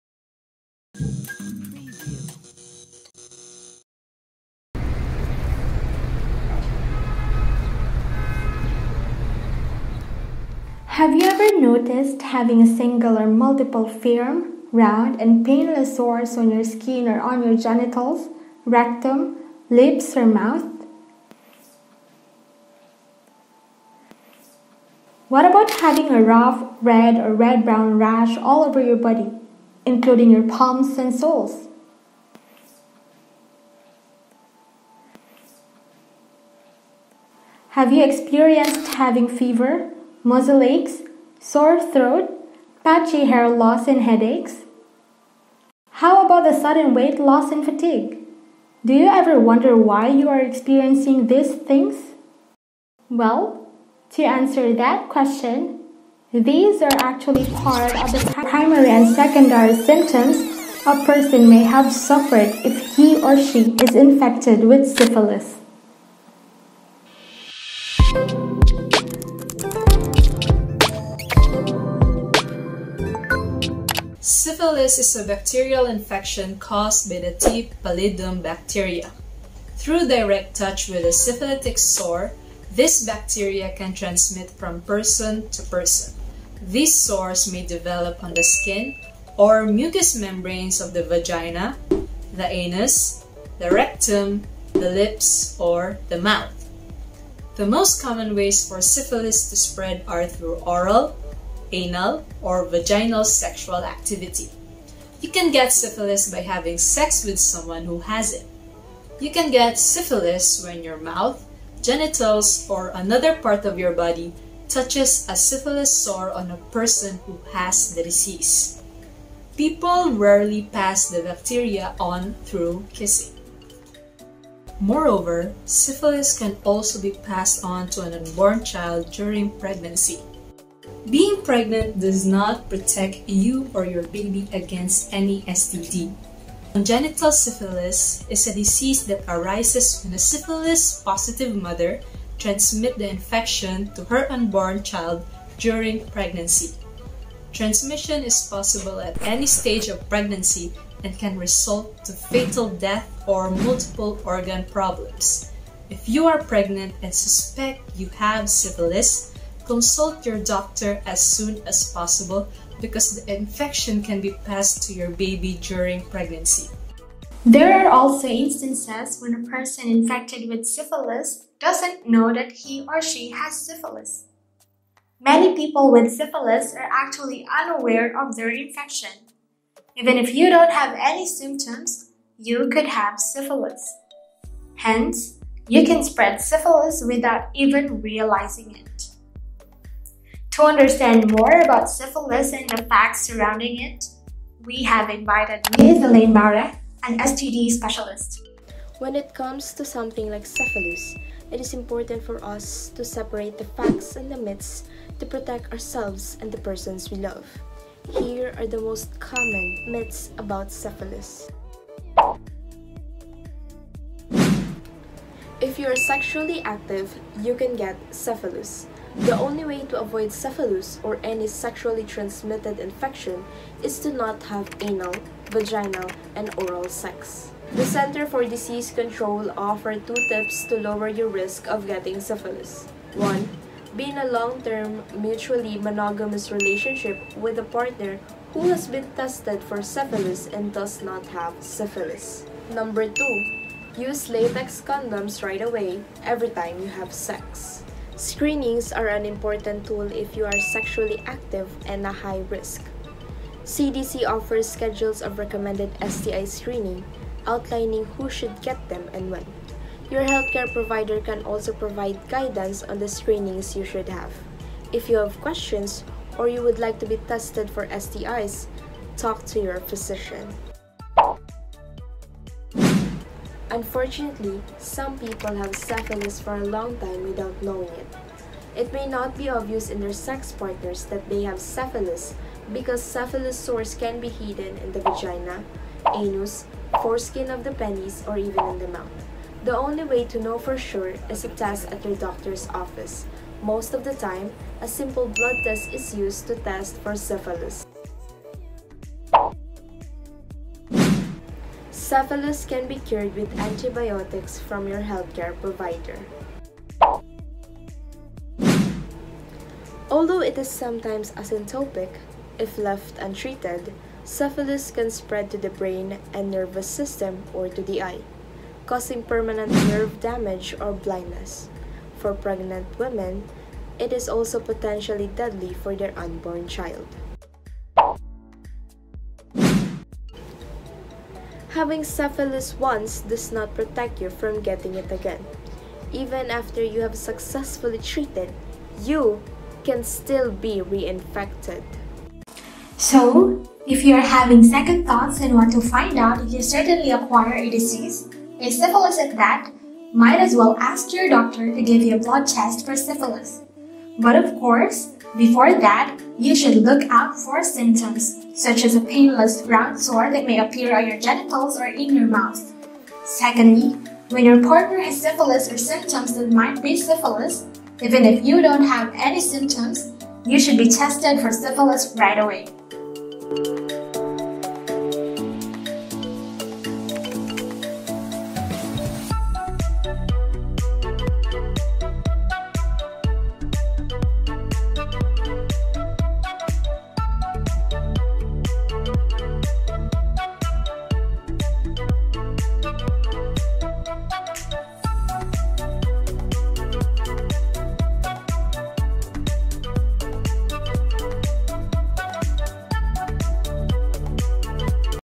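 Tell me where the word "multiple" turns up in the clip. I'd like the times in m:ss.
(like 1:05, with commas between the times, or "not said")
0:13, 2:33.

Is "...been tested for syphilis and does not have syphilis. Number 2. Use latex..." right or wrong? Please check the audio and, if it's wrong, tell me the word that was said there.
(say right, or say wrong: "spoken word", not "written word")
right.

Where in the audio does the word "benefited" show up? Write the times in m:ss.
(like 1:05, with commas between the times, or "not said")
not said.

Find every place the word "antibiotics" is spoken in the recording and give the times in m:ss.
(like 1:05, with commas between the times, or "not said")
5:03.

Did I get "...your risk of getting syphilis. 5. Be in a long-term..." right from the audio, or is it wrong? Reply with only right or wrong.
wrong.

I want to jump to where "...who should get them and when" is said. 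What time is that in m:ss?
4:18.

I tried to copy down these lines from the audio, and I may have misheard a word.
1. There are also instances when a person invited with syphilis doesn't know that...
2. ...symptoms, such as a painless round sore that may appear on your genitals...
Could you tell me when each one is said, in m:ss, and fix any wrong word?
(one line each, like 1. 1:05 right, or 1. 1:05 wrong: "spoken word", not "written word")
1. 2:47 wrong: "infected", not "invited"
2. 5:57 right.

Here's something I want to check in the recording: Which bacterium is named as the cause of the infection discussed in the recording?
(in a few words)
T. pallidum.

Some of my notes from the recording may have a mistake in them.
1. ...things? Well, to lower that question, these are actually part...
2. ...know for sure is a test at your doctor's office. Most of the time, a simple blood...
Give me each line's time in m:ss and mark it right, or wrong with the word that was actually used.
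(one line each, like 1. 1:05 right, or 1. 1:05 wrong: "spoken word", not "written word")
1. 0:51 wrong: "answer", not "lower"
2. 4:50 right.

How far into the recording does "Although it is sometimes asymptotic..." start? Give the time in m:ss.
5:10.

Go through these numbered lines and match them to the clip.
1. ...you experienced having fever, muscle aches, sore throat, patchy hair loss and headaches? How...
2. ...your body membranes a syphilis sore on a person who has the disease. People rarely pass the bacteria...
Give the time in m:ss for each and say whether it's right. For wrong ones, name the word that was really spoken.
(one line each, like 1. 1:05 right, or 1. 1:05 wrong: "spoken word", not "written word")
1. 0:37 right
2. 1:53 wrong: "touches", not "membranes".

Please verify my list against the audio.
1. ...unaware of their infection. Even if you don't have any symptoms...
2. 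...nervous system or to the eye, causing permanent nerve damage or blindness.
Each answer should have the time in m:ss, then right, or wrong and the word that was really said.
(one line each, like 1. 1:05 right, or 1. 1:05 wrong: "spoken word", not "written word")
1. 2:57 right
2. 5:16 right.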